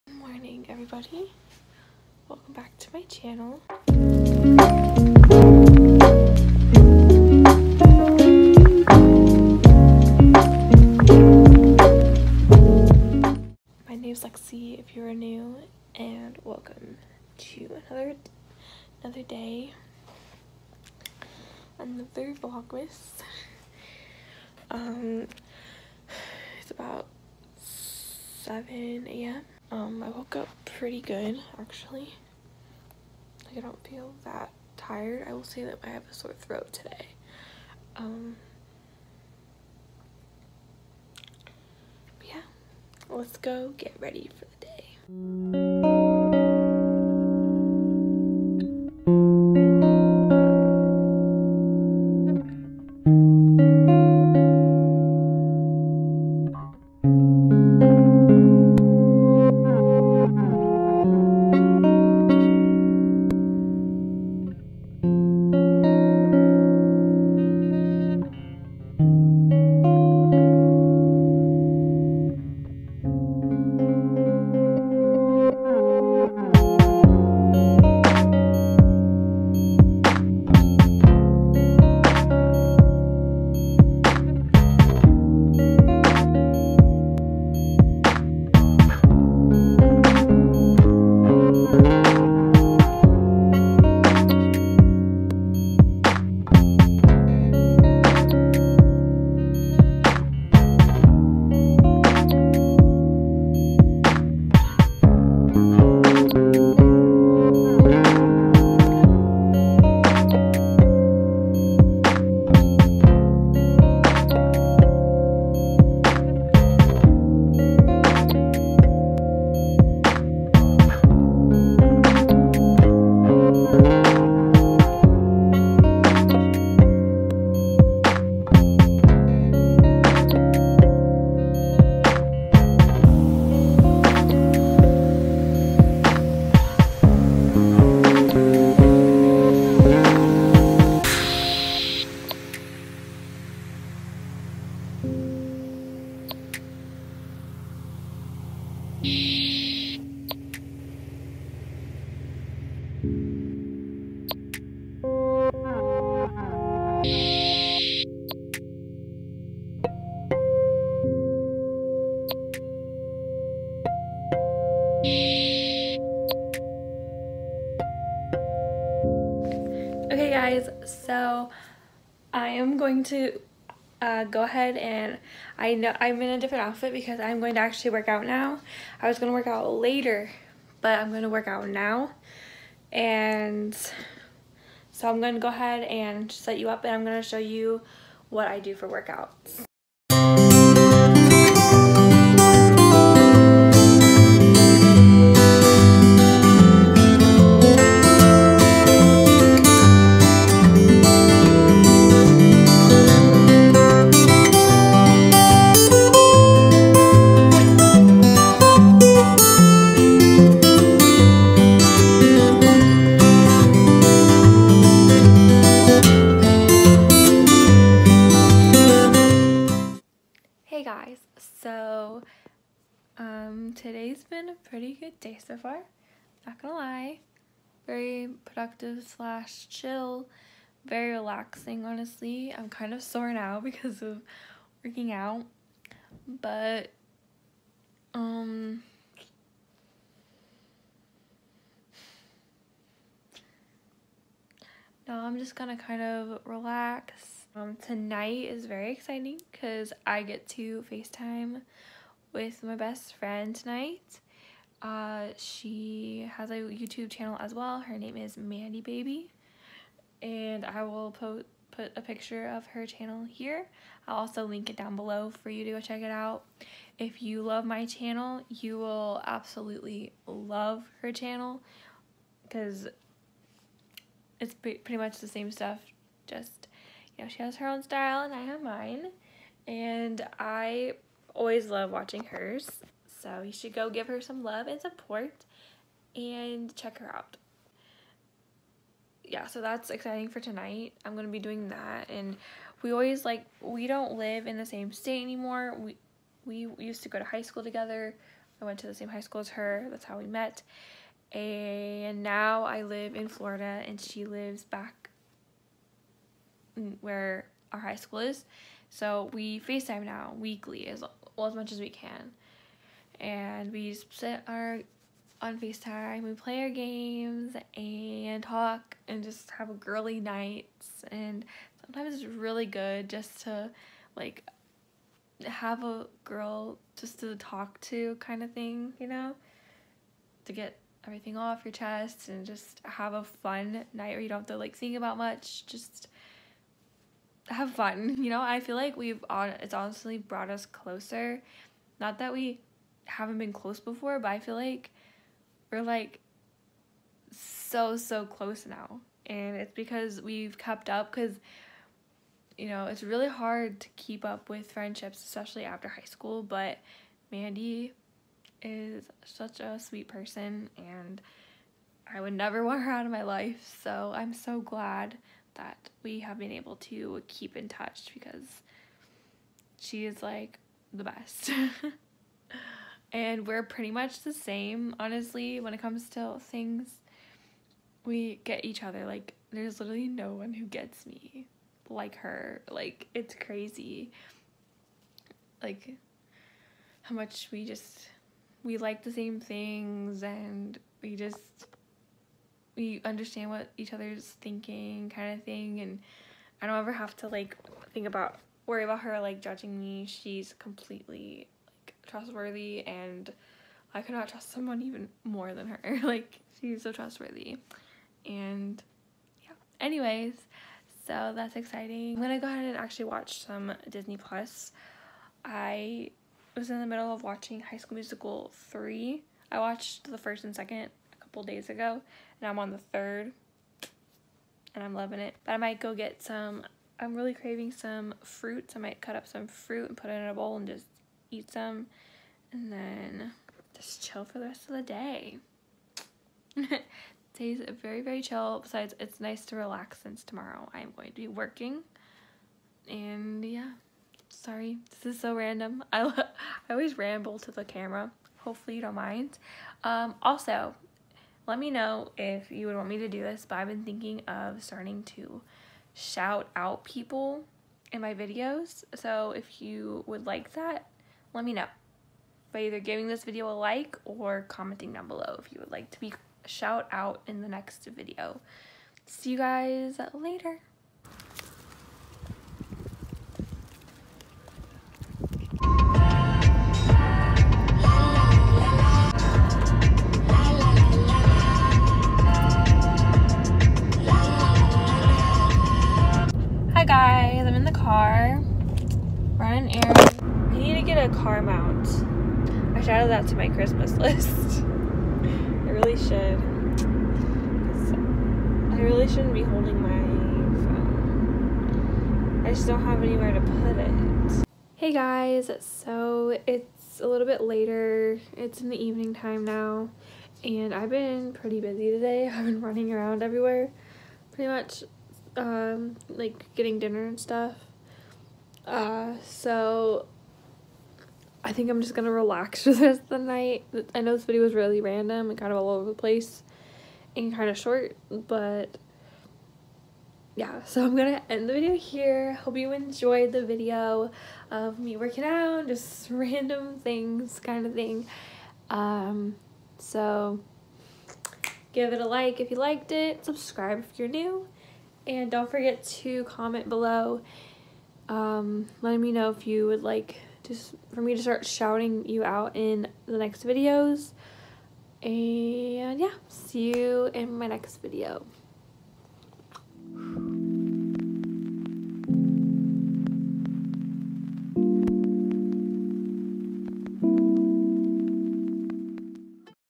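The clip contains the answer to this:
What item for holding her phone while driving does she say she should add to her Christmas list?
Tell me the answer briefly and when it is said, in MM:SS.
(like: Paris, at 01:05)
Car mount, at 08:11.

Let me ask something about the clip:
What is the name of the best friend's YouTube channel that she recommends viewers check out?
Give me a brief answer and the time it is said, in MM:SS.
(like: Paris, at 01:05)
Mandie Baby, at 04:18.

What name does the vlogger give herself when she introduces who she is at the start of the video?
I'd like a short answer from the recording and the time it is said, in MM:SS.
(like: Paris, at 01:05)
Lexi, at 00:14.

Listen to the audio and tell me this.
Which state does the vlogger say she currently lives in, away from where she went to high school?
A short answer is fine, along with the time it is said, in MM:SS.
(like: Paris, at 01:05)
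Florida, at 05:03.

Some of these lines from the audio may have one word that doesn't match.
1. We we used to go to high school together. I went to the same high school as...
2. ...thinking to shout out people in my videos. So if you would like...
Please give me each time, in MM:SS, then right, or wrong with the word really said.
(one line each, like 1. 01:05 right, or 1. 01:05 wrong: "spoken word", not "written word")
1. 04:55 right
2. 07:34 wrong: "starting", not "thinking".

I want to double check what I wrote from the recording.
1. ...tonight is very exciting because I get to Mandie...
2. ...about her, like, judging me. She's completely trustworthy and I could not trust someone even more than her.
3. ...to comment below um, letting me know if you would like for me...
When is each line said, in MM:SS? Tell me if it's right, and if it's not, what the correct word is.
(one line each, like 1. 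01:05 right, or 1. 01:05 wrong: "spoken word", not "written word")
1. 04:07 wrong: "FaceTime", not "Mandie"
2. 06:38 right
3. 09:05 right.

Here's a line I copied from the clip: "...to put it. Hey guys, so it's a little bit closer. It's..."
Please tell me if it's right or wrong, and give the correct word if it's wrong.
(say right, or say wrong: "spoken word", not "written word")
wrong: "later", not "closer".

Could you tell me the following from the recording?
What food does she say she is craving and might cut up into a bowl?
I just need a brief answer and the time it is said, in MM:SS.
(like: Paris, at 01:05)
Fruit, at 07:08.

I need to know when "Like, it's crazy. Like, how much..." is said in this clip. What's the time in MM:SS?
06:22.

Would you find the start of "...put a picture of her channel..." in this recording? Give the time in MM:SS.
04:21.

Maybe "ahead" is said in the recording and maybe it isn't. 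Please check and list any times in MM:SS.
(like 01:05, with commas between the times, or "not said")
02:54, 03:05, 06:52.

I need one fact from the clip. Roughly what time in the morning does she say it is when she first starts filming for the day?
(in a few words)
7 a.m.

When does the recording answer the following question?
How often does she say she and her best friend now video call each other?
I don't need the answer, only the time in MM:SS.
05:10.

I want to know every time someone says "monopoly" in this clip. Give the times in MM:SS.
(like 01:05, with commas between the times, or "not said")
not said.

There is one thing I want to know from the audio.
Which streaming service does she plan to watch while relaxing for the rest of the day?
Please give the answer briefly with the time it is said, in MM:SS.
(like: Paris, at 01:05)
Disney Plus, at 06:53.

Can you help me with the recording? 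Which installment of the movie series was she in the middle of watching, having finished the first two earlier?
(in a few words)
High School Musical 3.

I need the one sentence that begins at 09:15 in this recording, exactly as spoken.
And yeah, see you in my next video.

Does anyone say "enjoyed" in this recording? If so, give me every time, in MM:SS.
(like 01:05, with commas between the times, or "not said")
08:52.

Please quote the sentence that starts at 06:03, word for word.
So I'm so glad that we have been able to keep in touch because she is like the best.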